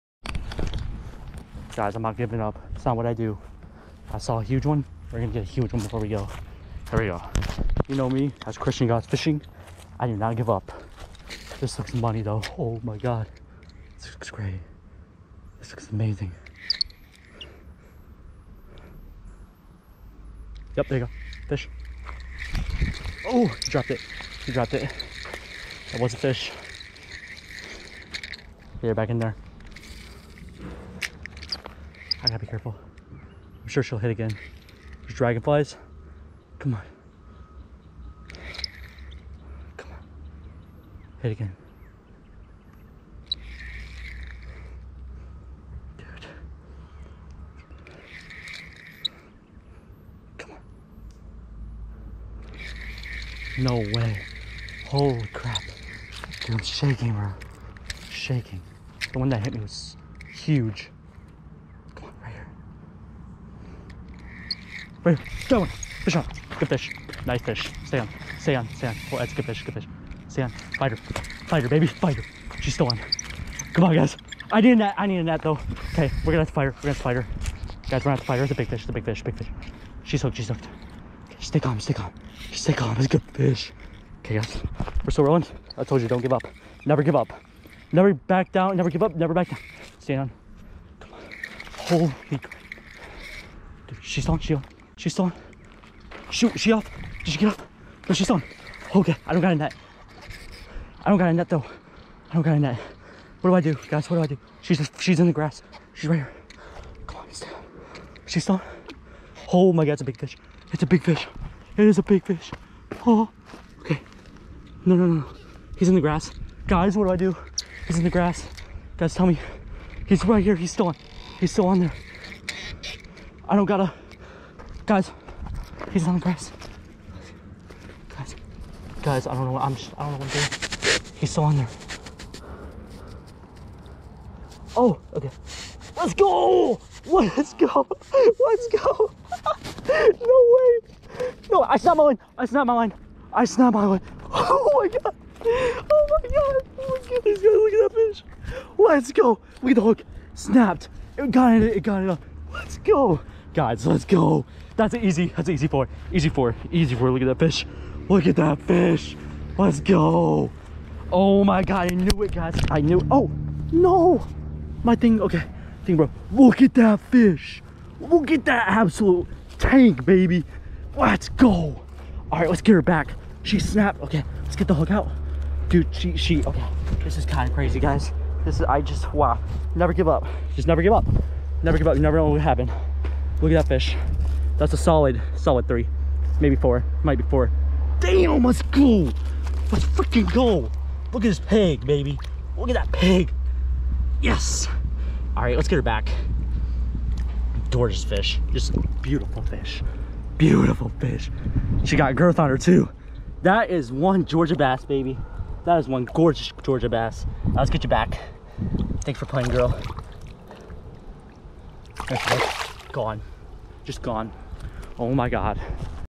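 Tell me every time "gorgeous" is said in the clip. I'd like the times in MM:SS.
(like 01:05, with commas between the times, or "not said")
03:17, 03:26.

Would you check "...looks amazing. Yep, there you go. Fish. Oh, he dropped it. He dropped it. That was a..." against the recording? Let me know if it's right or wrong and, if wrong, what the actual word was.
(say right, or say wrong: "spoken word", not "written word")
right.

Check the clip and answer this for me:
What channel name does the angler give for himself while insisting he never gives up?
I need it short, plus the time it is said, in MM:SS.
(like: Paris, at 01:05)
Christian Goss Fishing, at 00:08.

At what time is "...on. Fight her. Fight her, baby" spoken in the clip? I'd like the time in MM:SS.
01:10.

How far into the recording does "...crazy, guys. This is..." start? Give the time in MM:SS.
02:57.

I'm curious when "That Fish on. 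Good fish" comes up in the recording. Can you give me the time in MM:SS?
01:05.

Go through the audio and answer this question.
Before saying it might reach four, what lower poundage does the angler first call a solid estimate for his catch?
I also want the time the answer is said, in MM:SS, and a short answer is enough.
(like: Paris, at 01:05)
3, at 03:05.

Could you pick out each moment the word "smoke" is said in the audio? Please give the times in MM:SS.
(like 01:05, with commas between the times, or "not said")
not said.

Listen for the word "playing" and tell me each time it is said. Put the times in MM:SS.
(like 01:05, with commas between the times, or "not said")
03:29.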